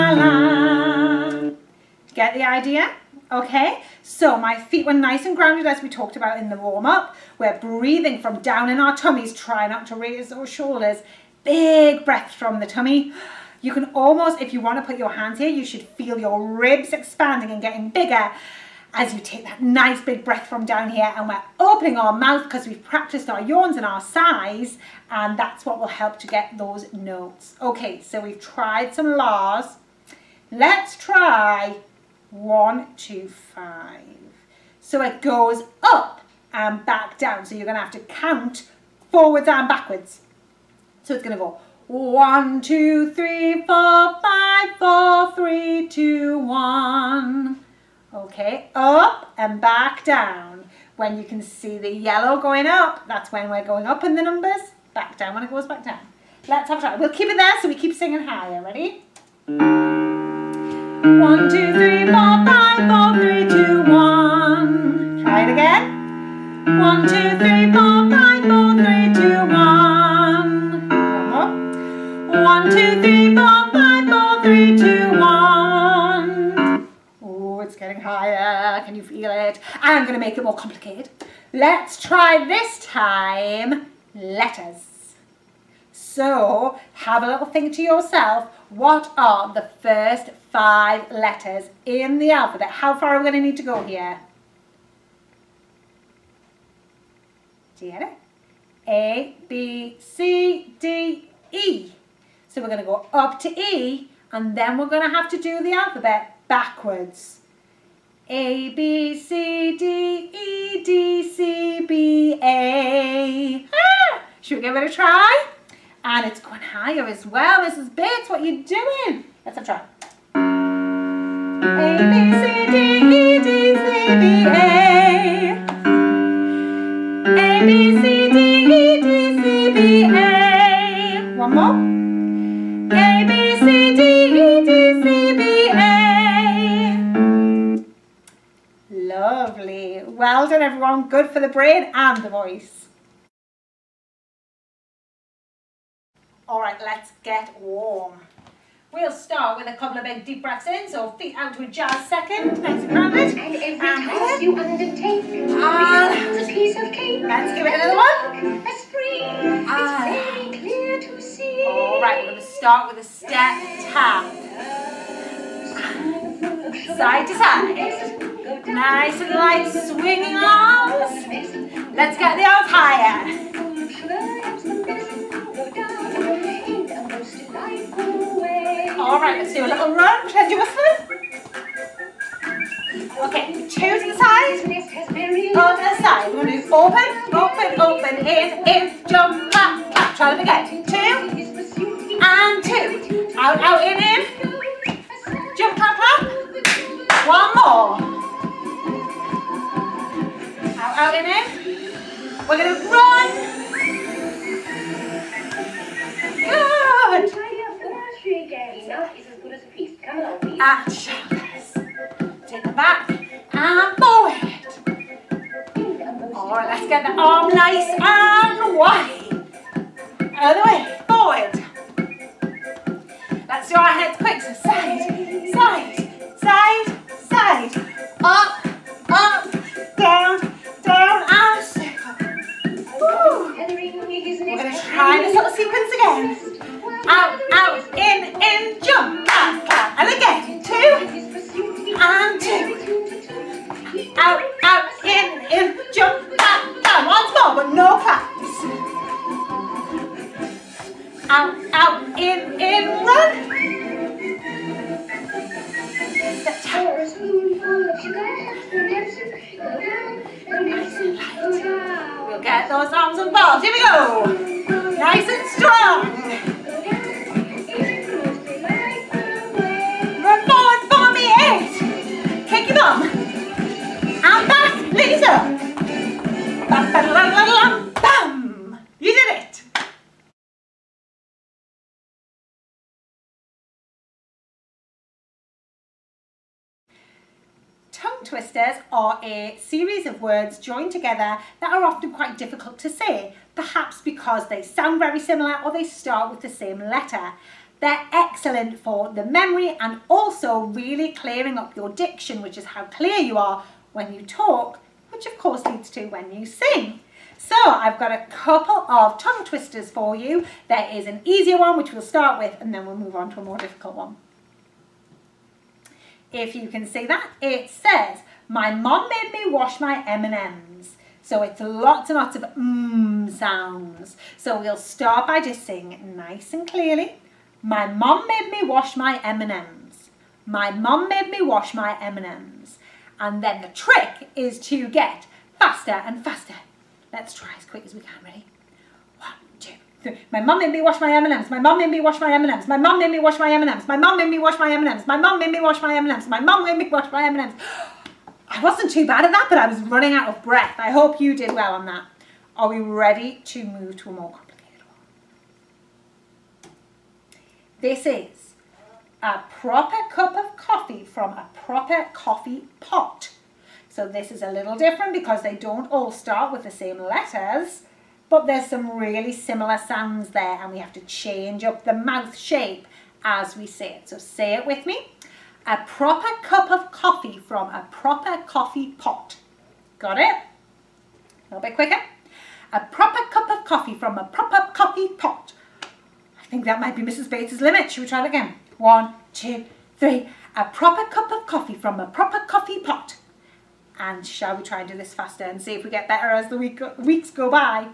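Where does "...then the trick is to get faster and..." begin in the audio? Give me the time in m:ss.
5:33.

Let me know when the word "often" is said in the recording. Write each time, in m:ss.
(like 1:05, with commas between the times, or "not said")
4:51.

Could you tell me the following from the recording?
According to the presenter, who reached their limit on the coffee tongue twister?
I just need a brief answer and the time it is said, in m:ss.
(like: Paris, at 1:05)
Mrs. Bates, at 6:27.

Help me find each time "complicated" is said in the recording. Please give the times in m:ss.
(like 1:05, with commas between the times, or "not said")
1:20, 5:54.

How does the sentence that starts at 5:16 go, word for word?
If you can see that, it says, my mom made me wash my M&Ms.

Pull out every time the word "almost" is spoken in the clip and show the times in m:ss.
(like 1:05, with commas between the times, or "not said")
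0:13.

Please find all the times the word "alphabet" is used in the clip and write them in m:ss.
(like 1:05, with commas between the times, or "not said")
1:32, 1:45.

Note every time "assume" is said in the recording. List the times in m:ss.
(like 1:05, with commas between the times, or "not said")
not said.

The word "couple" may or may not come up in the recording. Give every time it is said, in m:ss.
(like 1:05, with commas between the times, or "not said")
2:29, 5:08.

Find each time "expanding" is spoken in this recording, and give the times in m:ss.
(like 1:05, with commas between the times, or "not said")
0:16.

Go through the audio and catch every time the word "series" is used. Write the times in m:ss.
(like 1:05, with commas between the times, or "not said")
4:49.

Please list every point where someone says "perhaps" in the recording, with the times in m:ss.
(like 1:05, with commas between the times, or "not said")
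4:53.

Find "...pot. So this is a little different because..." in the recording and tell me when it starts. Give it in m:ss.
6:02.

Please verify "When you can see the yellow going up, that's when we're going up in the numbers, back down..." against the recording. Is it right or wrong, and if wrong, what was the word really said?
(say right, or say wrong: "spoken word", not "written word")
right.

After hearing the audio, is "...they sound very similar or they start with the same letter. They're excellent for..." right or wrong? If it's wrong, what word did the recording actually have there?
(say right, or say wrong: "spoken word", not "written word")
right.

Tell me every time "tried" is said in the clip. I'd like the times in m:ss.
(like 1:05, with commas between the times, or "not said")
0:28.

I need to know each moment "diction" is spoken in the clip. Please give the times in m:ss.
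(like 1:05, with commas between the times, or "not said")
5:01.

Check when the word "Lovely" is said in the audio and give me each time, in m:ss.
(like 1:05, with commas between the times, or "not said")
2:18.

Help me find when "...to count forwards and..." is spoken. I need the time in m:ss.
0:37.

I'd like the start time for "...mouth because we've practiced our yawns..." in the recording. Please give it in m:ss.
0:22.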